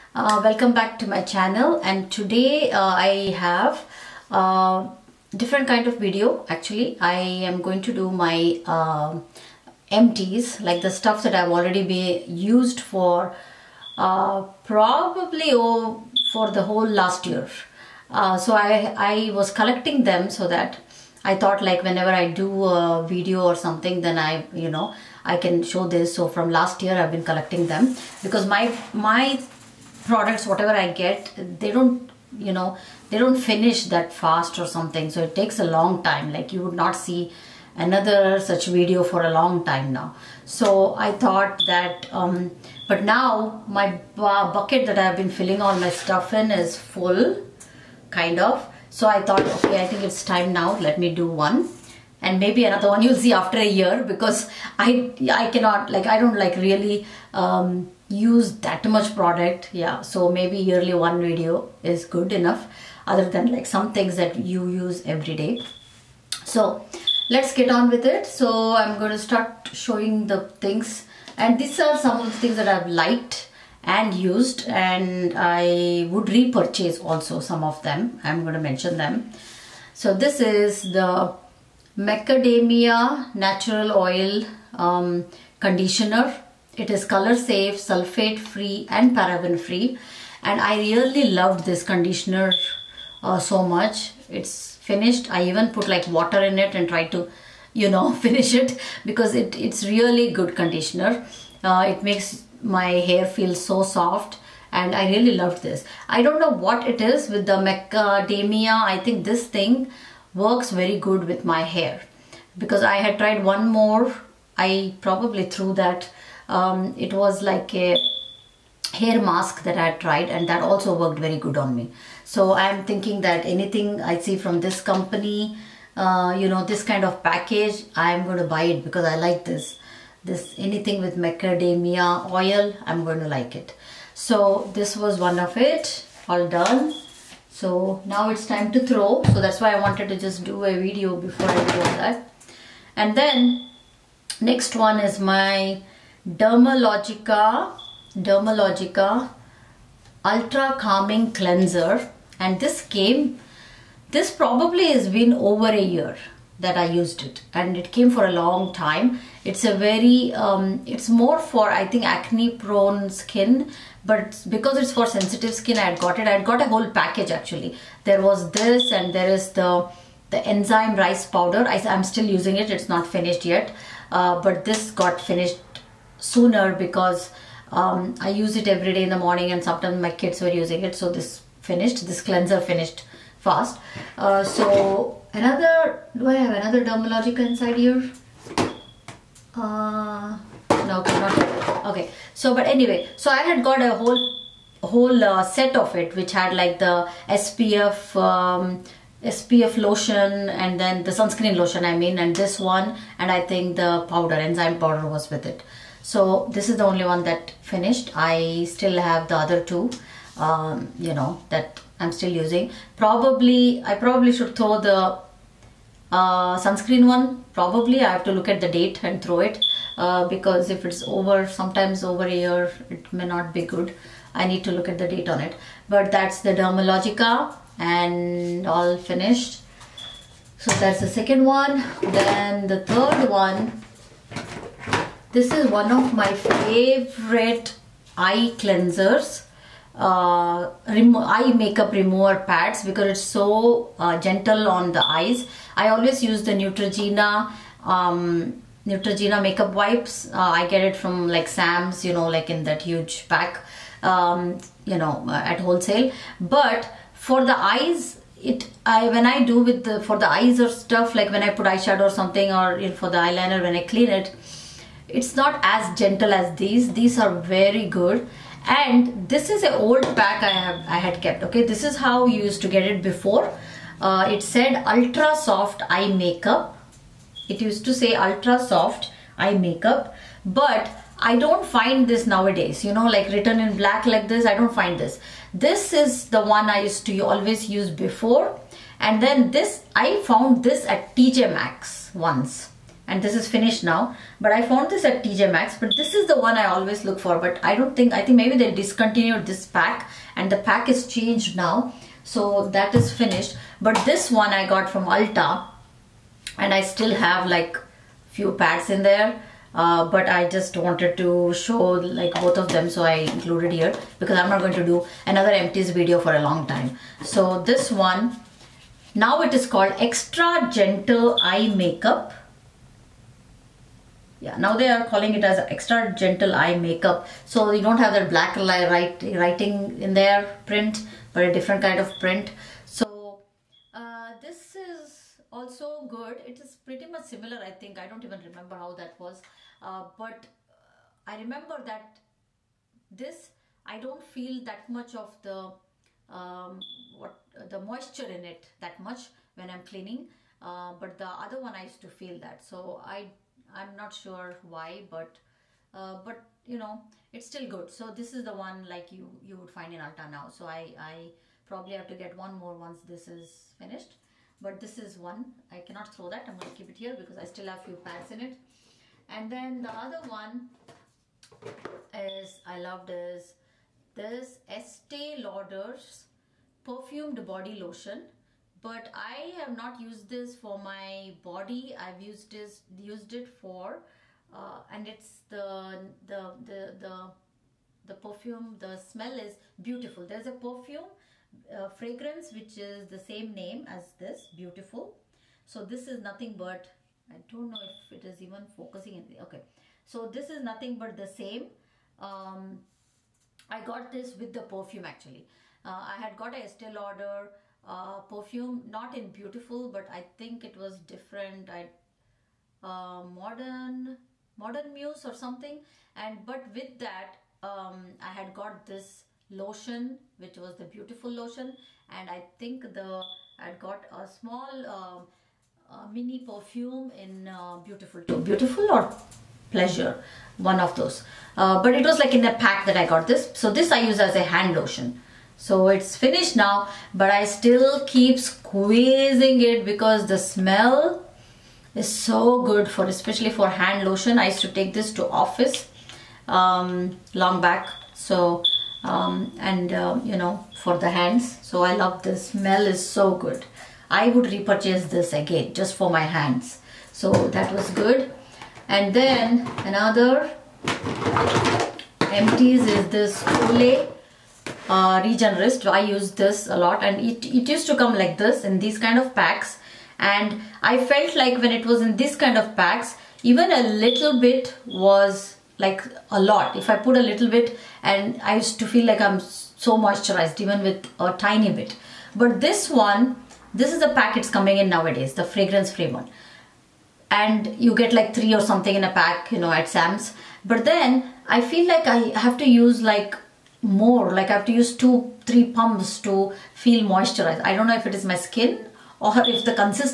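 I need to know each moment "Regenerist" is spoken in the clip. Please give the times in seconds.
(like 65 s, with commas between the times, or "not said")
465 s.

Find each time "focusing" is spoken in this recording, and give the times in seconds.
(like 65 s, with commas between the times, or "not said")
398 s.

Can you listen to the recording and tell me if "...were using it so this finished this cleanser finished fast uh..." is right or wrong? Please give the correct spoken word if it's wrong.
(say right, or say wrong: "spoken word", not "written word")
right.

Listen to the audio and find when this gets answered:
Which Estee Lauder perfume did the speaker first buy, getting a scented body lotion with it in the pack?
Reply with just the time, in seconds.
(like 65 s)
413 s.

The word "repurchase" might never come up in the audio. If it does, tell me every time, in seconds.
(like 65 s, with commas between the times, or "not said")
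76 s, 454 s.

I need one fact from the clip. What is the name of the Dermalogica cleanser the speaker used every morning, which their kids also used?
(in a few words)
Ultra Calming Cleanser.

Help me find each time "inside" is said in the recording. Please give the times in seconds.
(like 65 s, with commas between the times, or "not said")
187 s.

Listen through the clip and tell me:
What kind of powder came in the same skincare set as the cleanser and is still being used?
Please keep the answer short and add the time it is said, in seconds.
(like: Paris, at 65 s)
enzyme rice powder, at 170 s.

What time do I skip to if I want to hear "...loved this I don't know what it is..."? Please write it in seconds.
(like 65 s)
105 s.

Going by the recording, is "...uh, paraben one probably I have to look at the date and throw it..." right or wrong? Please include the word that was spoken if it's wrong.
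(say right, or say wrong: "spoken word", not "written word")
wrong: "sunscreen", not "paraben".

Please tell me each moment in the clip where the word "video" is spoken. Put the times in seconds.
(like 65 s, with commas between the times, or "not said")
5 s, 23 s, 38 s, 61 s, 140 s, 315 s.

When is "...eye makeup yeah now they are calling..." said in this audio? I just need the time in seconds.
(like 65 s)
321 s.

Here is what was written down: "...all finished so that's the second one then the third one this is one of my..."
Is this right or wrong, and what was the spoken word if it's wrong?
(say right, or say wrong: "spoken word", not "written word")
right.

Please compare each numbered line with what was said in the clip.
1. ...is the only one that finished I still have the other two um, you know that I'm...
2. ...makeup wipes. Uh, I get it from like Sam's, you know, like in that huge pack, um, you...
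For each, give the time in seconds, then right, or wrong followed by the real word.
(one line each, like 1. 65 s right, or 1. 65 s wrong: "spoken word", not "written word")
1. 206 s right
2. 249 s right.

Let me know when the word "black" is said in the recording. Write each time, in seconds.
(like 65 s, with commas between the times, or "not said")
283 s, 328 s.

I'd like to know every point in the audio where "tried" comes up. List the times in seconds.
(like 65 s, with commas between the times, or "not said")
96 s, 113 s, 120 s.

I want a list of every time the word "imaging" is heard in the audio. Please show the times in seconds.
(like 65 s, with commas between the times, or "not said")
not said.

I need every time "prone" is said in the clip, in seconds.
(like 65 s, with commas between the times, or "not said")
162 s.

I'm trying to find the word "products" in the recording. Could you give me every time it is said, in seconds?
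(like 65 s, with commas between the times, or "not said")
30 s, 59 s.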